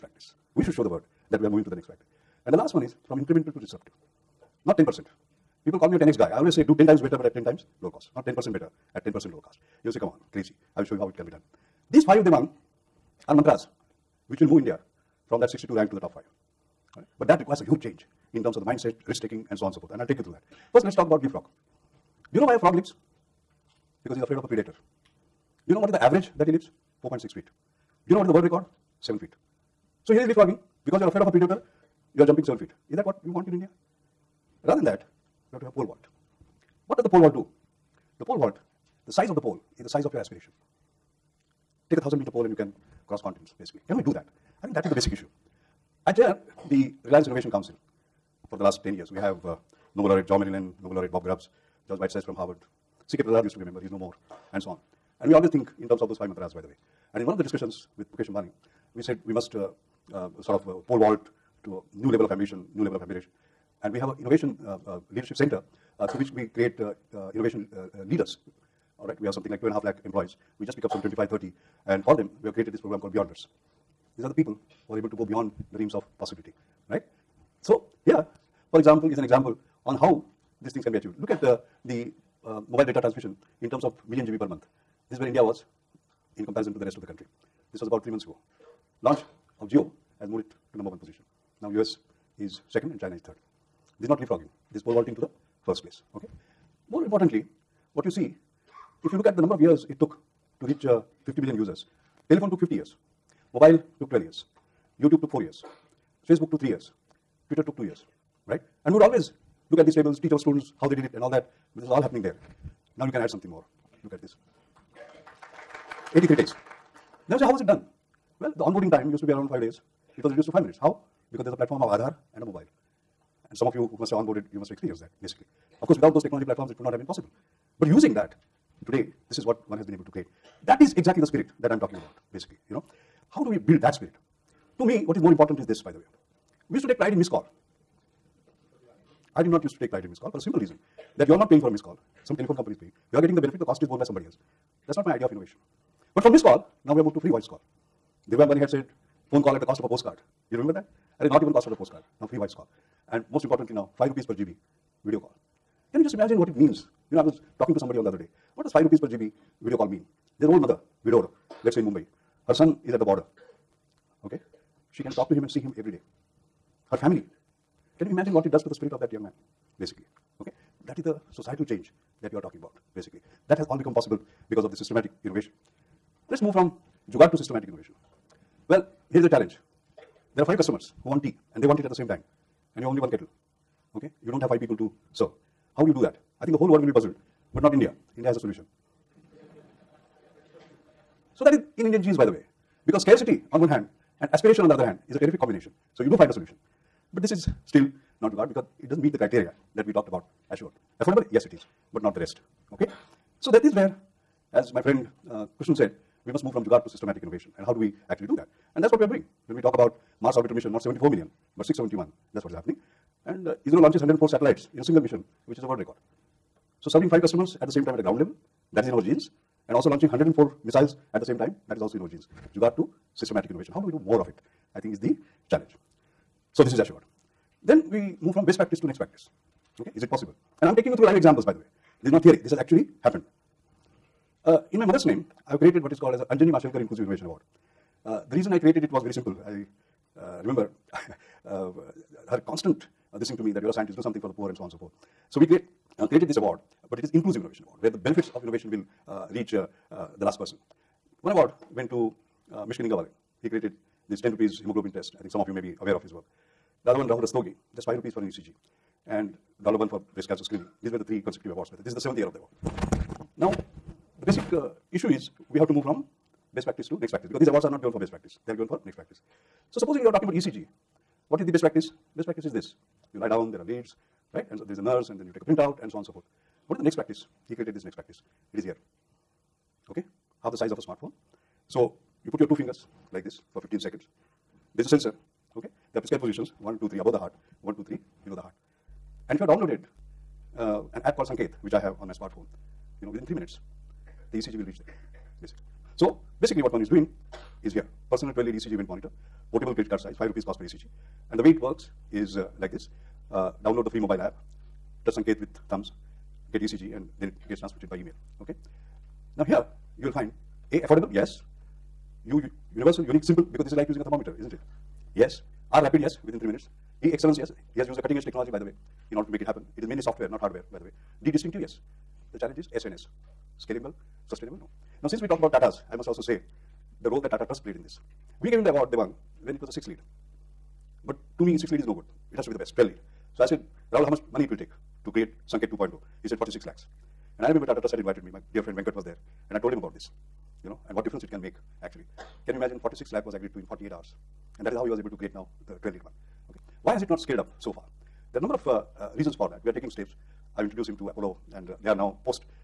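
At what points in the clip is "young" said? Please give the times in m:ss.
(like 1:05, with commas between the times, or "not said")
2:49.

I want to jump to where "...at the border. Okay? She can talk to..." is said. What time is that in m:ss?
2:42.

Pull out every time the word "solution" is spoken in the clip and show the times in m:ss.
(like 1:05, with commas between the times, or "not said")
3:08, 3:16.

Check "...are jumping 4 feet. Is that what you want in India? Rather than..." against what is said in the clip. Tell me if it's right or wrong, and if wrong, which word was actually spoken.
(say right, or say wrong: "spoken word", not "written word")
wrong: "7", not "4".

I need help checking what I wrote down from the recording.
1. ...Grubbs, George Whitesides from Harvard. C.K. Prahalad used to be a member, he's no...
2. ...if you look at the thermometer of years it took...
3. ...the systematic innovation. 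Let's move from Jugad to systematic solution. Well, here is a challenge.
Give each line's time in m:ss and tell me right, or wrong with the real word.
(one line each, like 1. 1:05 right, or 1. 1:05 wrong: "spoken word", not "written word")
1. 0:51 right
2. 1:39 wrong: "number", not "thermometer"
3. 2:54 wrong: "innovation", not "solution".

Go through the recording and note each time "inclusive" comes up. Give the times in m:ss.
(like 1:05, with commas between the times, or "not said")
3:56, 4:07.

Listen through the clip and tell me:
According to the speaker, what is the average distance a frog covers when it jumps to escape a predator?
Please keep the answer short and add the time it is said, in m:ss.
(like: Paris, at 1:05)
4.6 feet, at 0:27.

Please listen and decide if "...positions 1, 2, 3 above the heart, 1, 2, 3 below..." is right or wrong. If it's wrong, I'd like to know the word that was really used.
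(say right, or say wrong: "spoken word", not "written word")
right.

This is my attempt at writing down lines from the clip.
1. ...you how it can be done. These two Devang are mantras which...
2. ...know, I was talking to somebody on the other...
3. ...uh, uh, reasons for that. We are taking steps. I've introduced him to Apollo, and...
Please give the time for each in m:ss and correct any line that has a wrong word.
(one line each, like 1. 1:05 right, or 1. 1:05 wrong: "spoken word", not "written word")
1. 0:10 wrong: "five", not "two"
2. 2:37 right
3. 5:48 right.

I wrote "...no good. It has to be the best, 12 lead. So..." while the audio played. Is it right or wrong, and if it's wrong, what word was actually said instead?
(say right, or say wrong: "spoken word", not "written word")
right.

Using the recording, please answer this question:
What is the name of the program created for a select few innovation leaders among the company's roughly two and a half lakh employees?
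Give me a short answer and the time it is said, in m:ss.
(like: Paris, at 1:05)
Beyonders, at 1:13.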